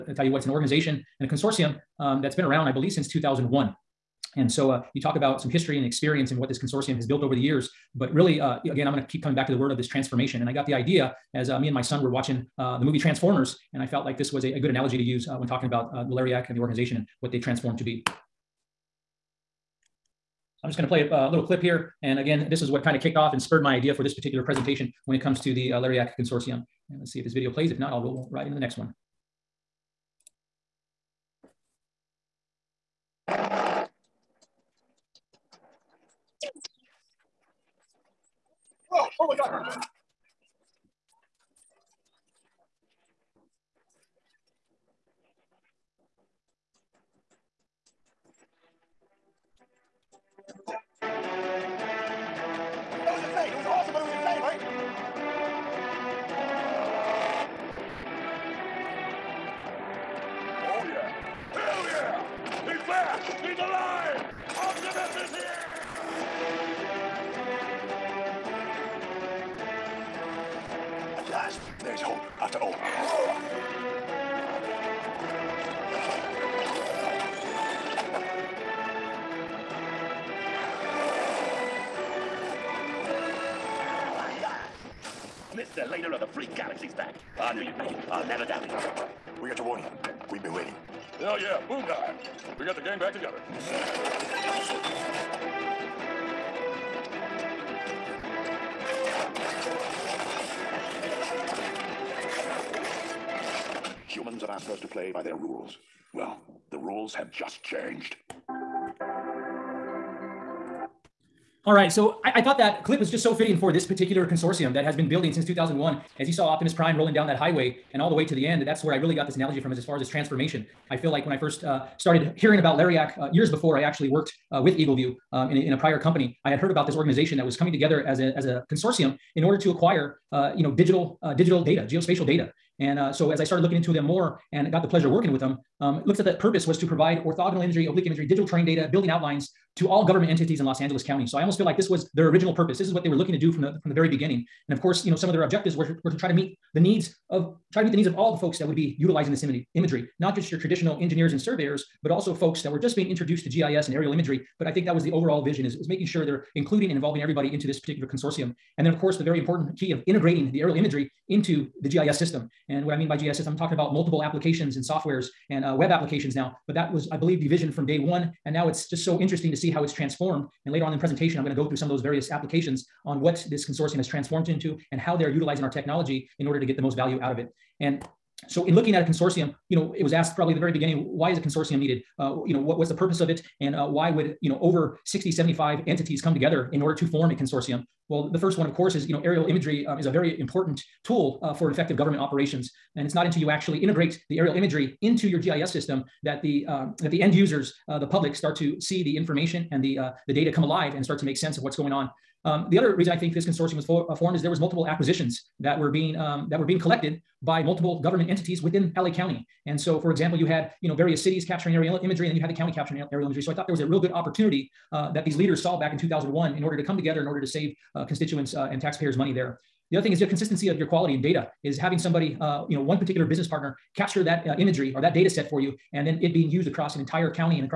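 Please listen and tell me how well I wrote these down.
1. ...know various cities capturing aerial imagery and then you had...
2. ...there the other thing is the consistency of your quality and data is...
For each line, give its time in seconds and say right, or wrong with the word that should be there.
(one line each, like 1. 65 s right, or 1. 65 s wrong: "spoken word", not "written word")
1. 210 s right
2. 219 s right.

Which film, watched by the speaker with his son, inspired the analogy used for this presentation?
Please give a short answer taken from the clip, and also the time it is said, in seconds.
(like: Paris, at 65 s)
Transformers, at 12 s.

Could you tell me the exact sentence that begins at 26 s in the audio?
And let's see if this video plays.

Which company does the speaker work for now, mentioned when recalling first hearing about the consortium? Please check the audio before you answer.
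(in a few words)
EagleView.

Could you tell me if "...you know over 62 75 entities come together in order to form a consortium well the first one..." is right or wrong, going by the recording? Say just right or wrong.
wrong.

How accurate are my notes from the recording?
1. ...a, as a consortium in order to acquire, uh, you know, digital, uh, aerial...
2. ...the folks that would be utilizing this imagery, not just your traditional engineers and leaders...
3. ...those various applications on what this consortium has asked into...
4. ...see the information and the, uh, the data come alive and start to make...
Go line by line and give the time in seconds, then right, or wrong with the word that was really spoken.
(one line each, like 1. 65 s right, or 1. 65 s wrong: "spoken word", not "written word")
1. 128 s wrong: "digital", not "aerial"
2. 148 s wrong: "surveyors", not "leaders"
3. 171 s wrong: "transformed", not "asked"
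4. 198 s right.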